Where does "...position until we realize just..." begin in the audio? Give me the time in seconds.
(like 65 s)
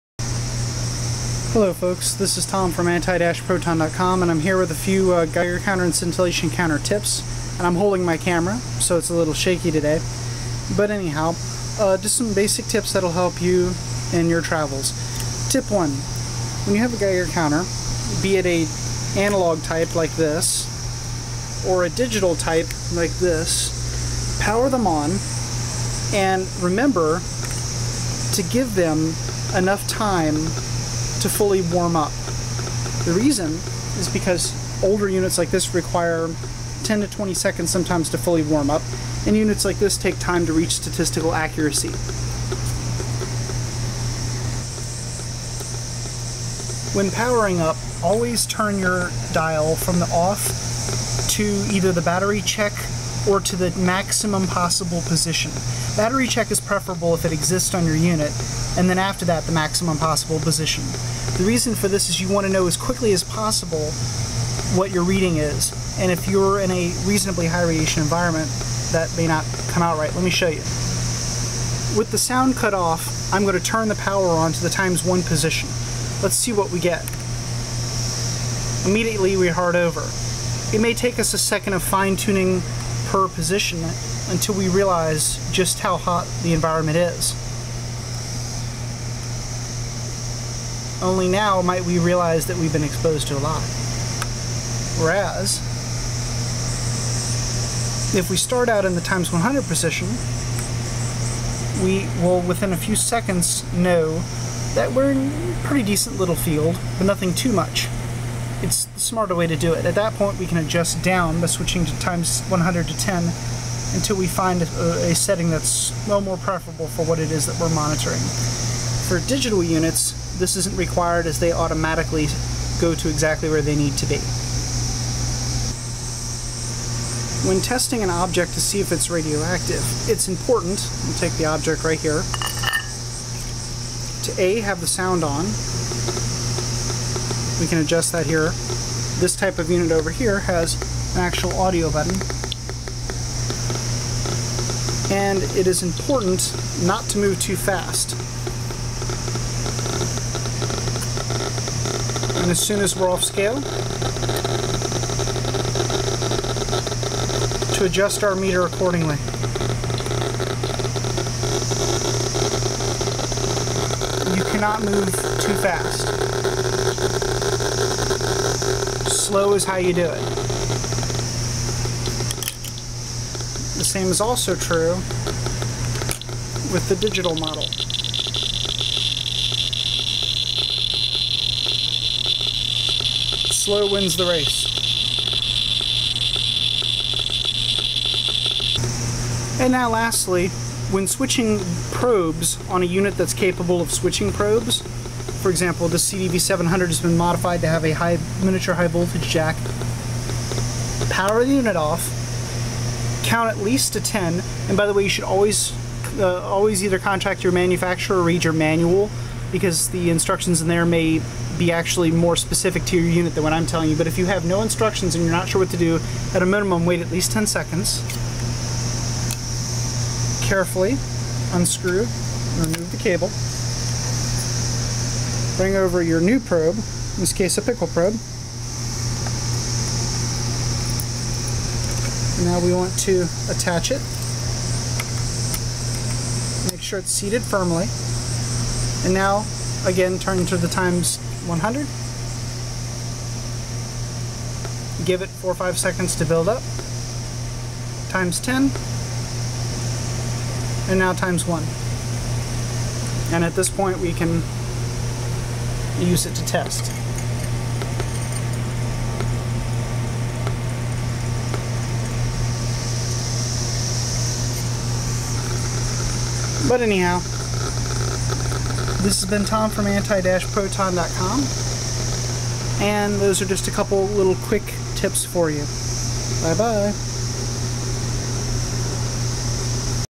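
83 s.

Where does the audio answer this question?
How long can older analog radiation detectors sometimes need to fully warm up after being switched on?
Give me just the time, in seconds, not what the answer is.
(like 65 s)
36 s.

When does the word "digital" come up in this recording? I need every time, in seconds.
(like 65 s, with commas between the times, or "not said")
21 s, 119 s, 176 s.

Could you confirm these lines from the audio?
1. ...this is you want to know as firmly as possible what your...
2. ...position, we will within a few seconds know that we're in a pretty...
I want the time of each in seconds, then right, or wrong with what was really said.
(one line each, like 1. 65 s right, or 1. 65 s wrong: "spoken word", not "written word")
1. 61 s wrong: "quickly", not "firmly"
2. 99 s right.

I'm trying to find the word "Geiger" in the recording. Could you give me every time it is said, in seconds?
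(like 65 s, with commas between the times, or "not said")
5 s, 16 s.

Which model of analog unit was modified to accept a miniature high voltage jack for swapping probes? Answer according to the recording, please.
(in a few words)
CDV700.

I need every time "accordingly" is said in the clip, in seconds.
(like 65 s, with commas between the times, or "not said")
158 s.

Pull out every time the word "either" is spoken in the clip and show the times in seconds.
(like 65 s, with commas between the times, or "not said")
51 s, 206 s.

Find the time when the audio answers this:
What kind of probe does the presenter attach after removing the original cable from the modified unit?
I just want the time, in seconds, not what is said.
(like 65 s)
227 s.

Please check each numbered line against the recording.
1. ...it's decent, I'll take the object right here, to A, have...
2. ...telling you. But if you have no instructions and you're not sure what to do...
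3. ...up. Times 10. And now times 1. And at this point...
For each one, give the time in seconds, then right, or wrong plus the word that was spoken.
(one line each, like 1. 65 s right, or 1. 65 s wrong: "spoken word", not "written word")
1. 130 s wrong: "important", not "decent"
2. 213 s right
3. 246 s right.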